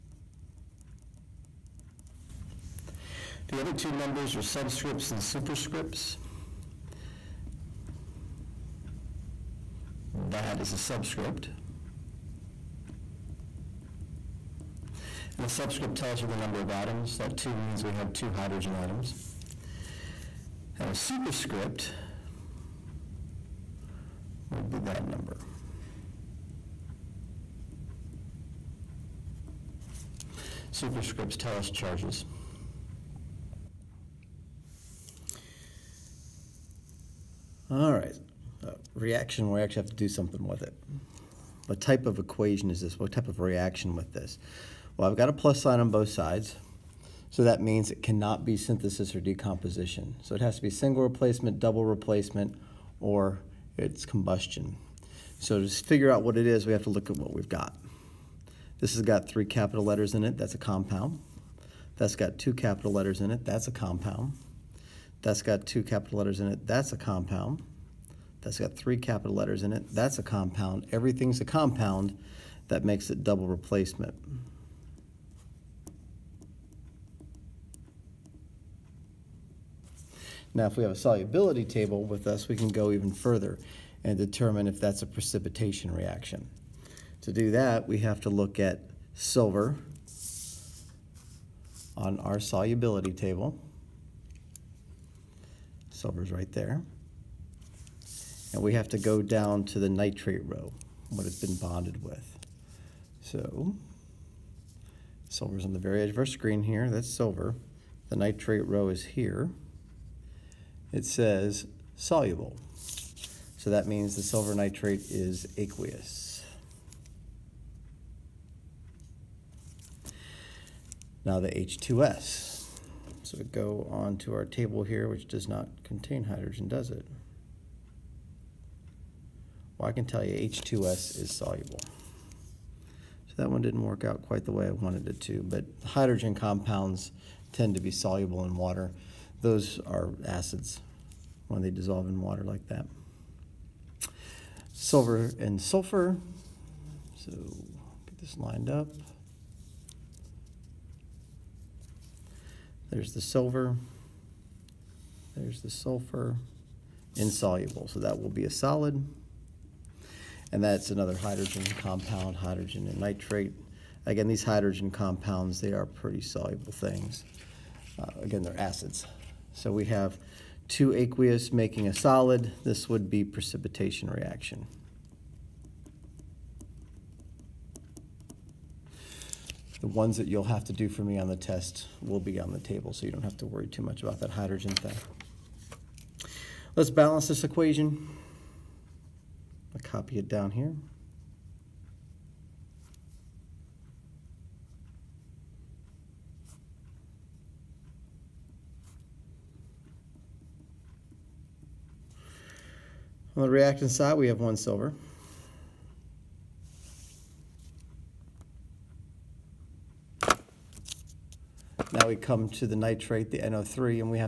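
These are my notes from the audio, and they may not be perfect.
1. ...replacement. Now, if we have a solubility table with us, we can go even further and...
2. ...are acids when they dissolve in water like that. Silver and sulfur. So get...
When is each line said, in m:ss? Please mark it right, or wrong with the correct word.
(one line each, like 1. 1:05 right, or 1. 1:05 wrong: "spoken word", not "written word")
1. 1:13 right
2. 2:19 right.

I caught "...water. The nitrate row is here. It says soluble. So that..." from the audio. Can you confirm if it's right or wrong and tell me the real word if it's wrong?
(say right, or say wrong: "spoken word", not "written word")
wrong: "silver", not "water".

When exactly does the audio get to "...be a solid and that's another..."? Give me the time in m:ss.
2:38.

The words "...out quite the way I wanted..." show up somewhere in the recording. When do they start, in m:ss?
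2:14.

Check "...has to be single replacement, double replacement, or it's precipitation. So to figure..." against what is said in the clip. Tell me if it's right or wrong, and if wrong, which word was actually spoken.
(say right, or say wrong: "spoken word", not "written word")
wrong: "combustion", not "precipitation".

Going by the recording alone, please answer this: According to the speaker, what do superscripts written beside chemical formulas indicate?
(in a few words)
Charges.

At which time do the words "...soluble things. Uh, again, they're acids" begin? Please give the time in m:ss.
2:46.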